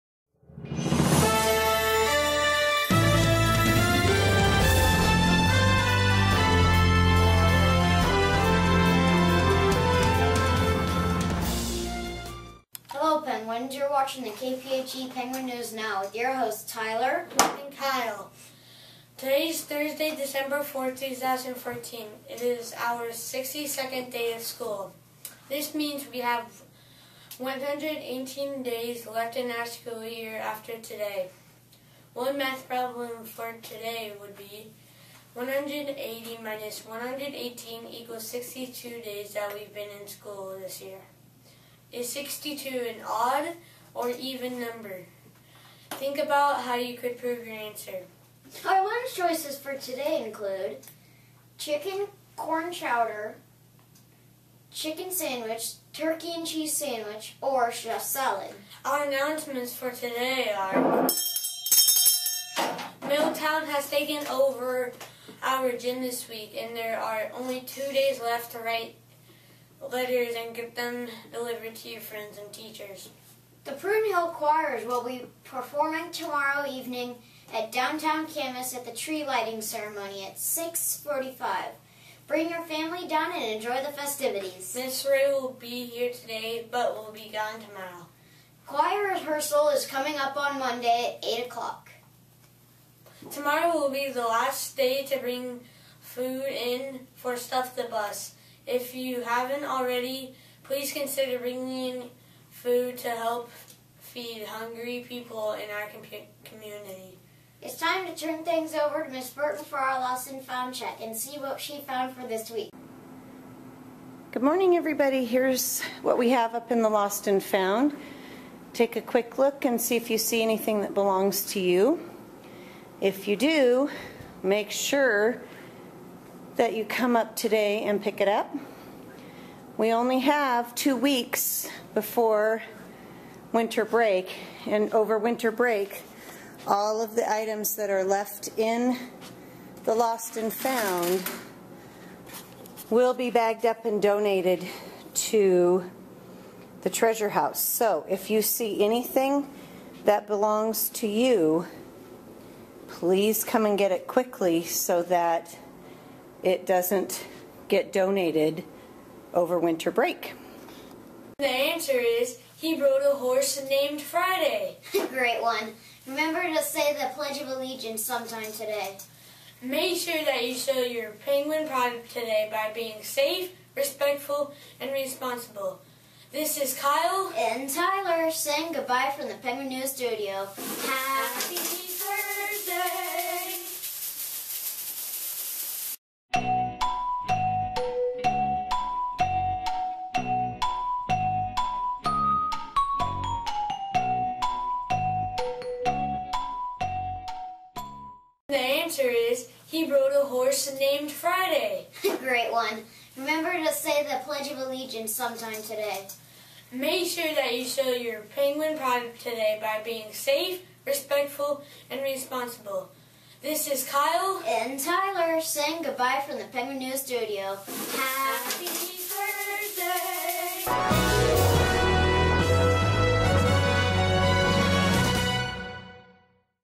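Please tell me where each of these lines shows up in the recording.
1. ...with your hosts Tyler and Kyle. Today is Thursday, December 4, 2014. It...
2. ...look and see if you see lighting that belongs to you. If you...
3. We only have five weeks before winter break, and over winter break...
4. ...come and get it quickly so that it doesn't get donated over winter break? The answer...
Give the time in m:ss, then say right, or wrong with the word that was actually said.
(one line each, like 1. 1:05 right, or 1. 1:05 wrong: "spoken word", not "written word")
1. 0:16 right
2. 1:59 wrong: "anything", not "lighting"
3. 2:09 wrong: "two", not "five"
4. 2:33 right.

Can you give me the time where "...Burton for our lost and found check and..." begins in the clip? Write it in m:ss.
1:49.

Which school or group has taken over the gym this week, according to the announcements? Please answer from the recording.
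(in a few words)
Milltown.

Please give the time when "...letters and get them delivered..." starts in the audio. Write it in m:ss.
1:09.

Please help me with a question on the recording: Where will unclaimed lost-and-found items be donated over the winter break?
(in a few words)
The treasure house.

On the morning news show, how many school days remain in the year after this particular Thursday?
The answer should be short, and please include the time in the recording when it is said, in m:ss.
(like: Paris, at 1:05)
118, at 0:27.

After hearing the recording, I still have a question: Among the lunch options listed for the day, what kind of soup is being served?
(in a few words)
Chicken corn chowder.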